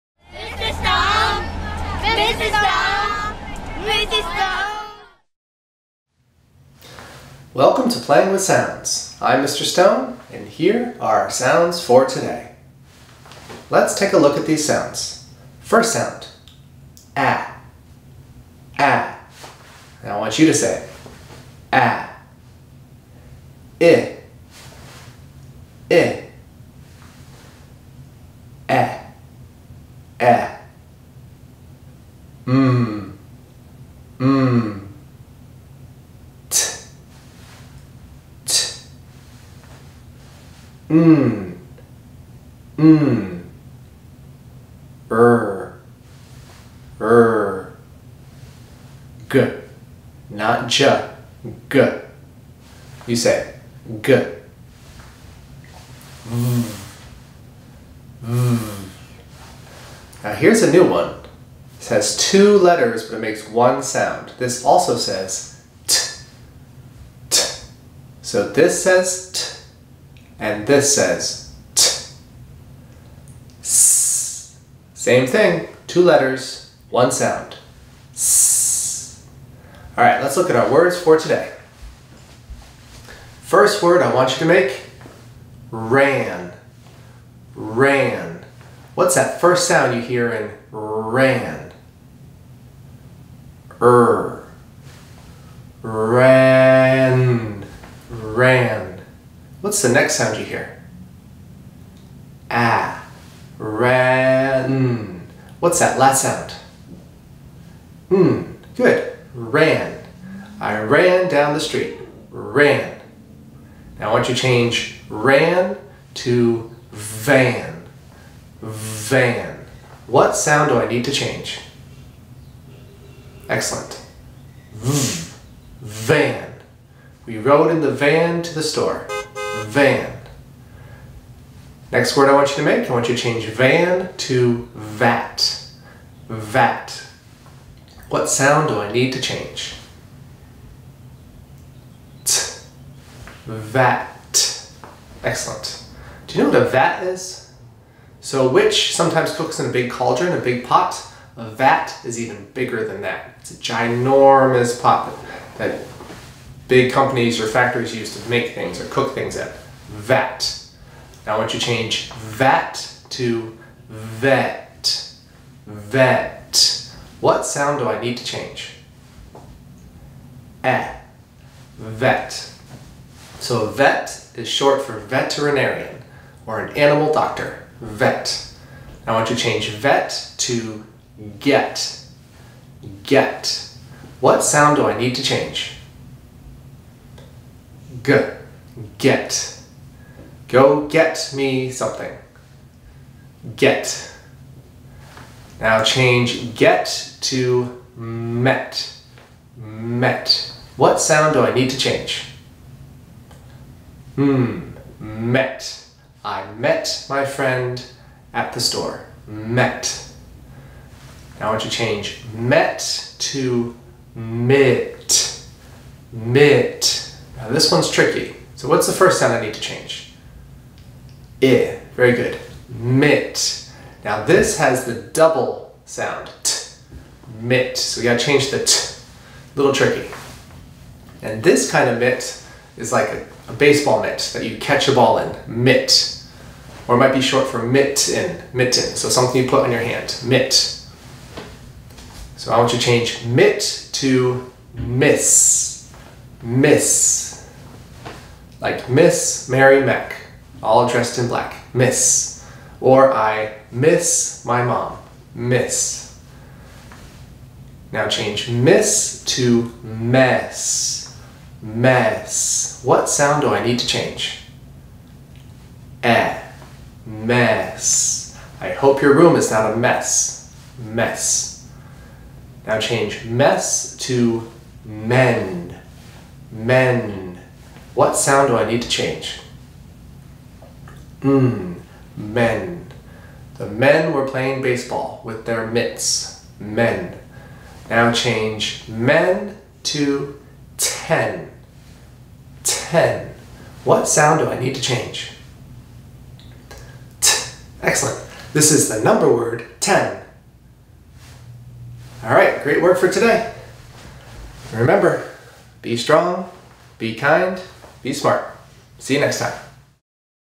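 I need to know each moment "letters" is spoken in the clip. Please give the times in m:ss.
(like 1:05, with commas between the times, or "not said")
1:02, 1:16.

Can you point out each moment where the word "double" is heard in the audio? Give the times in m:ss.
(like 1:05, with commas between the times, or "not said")
3:44.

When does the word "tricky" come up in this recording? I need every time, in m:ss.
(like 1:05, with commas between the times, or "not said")
3:37, 3:49.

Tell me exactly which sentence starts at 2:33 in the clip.
It's a ginormous pot that big companies or factories use to make things or cook things at Vat.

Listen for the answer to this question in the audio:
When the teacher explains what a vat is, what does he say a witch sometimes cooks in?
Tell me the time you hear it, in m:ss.
2:29.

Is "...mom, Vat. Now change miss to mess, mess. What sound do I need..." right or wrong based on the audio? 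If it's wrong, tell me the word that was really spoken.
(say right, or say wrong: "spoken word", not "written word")
wrong: "Miss", not "Vat".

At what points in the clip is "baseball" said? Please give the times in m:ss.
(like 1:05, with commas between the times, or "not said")
3:53, 4:44.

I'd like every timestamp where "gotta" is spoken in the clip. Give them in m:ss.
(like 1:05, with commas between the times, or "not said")
3:48.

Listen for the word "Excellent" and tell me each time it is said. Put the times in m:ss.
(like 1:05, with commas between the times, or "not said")
2:03, 2:25, 4:57.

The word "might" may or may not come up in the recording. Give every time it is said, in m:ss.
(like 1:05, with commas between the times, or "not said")
3:56.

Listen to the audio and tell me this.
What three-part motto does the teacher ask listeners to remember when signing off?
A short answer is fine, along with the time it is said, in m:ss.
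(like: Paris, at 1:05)
be strong, be kind, be smart, at 5:05.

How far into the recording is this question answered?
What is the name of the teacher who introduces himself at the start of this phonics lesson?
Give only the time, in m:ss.
0:09.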